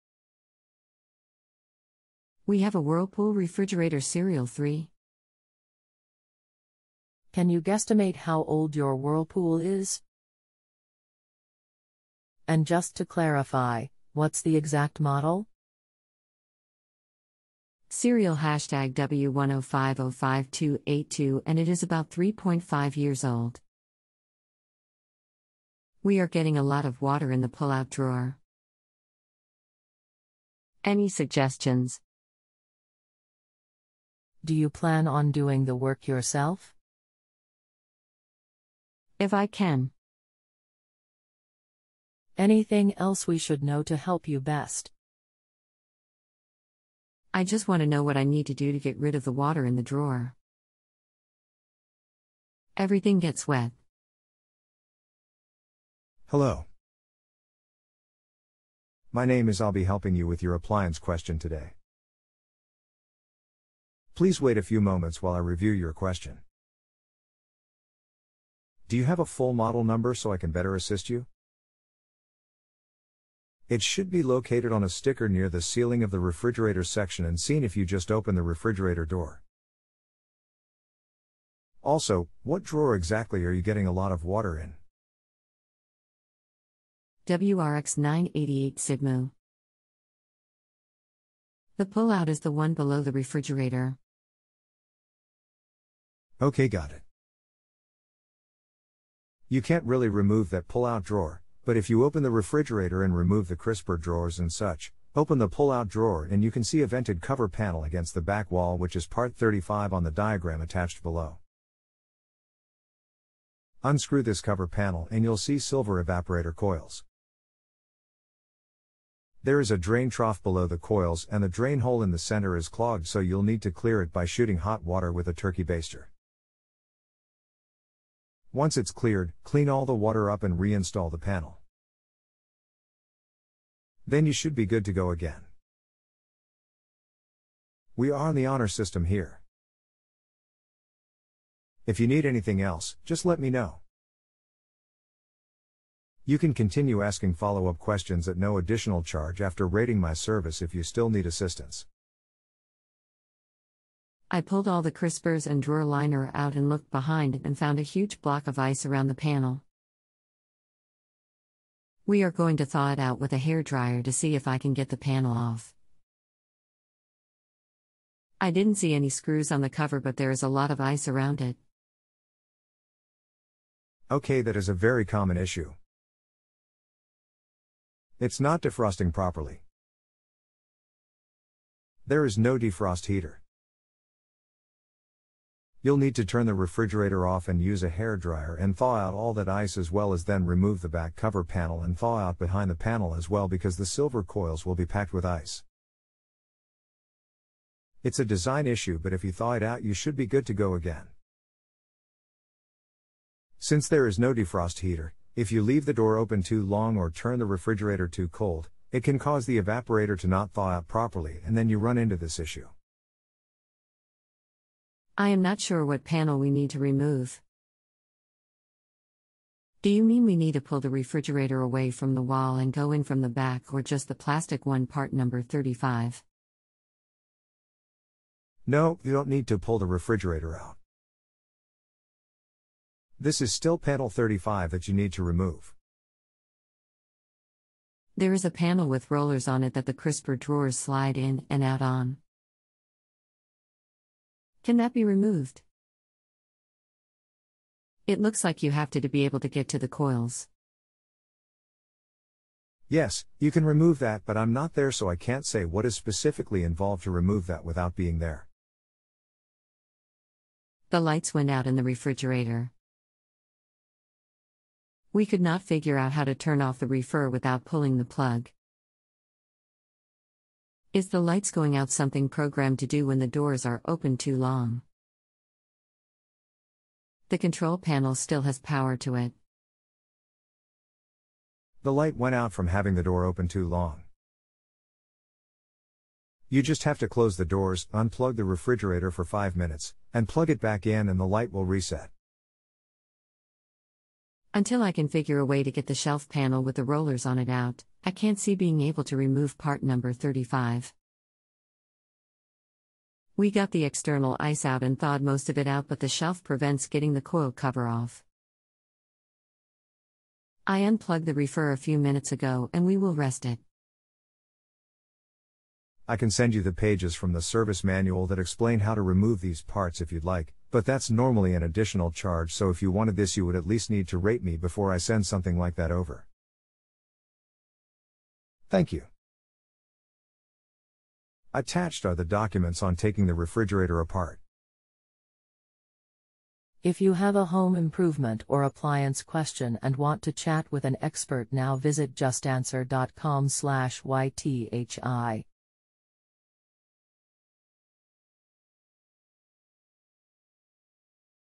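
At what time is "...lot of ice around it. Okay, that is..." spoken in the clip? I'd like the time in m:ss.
2:50.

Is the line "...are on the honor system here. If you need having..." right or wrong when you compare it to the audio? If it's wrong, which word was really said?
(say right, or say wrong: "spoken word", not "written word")
wrong: "anything", not "having".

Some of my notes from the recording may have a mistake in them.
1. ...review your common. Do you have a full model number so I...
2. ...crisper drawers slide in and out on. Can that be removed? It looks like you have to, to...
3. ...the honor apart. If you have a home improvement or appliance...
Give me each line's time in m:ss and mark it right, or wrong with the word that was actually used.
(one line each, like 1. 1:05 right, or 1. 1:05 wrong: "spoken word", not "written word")
1. 1:05 wrong: "question", not "common"
2. 3:59 right
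3. 5:33 wrong: "refrigerator", not "honor".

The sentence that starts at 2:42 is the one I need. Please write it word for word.
We are going to thaw it out with a hair dryer to see if I can get the panel off.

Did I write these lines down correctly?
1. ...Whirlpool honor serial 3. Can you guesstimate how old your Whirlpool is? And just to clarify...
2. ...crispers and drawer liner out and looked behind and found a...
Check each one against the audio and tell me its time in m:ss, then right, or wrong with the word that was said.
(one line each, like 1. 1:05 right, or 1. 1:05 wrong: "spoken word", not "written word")
1. 0:02 wrong: "refrigerator", not "honor"
2. 2:34 right.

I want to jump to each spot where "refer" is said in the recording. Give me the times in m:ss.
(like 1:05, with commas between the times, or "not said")
4:26, 5:11.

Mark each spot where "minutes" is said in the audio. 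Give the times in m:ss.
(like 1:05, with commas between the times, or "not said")
4:49, 5:11.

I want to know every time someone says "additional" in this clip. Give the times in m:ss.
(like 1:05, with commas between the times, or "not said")
2:28, 5:21.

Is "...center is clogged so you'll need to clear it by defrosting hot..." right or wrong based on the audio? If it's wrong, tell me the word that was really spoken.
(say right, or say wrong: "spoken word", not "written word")
wrong: "shooting", not "defrosting".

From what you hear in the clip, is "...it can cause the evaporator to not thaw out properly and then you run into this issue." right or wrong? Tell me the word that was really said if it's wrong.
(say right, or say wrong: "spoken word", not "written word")
right.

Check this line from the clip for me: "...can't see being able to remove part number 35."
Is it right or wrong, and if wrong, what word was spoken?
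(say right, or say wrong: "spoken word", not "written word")
right.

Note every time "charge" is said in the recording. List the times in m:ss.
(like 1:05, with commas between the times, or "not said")
2:29, 5:22.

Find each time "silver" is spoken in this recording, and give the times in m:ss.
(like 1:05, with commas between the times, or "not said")
1:55, 3:13.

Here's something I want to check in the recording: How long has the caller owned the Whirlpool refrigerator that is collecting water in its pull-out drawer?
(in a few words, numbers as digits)
3.5 years.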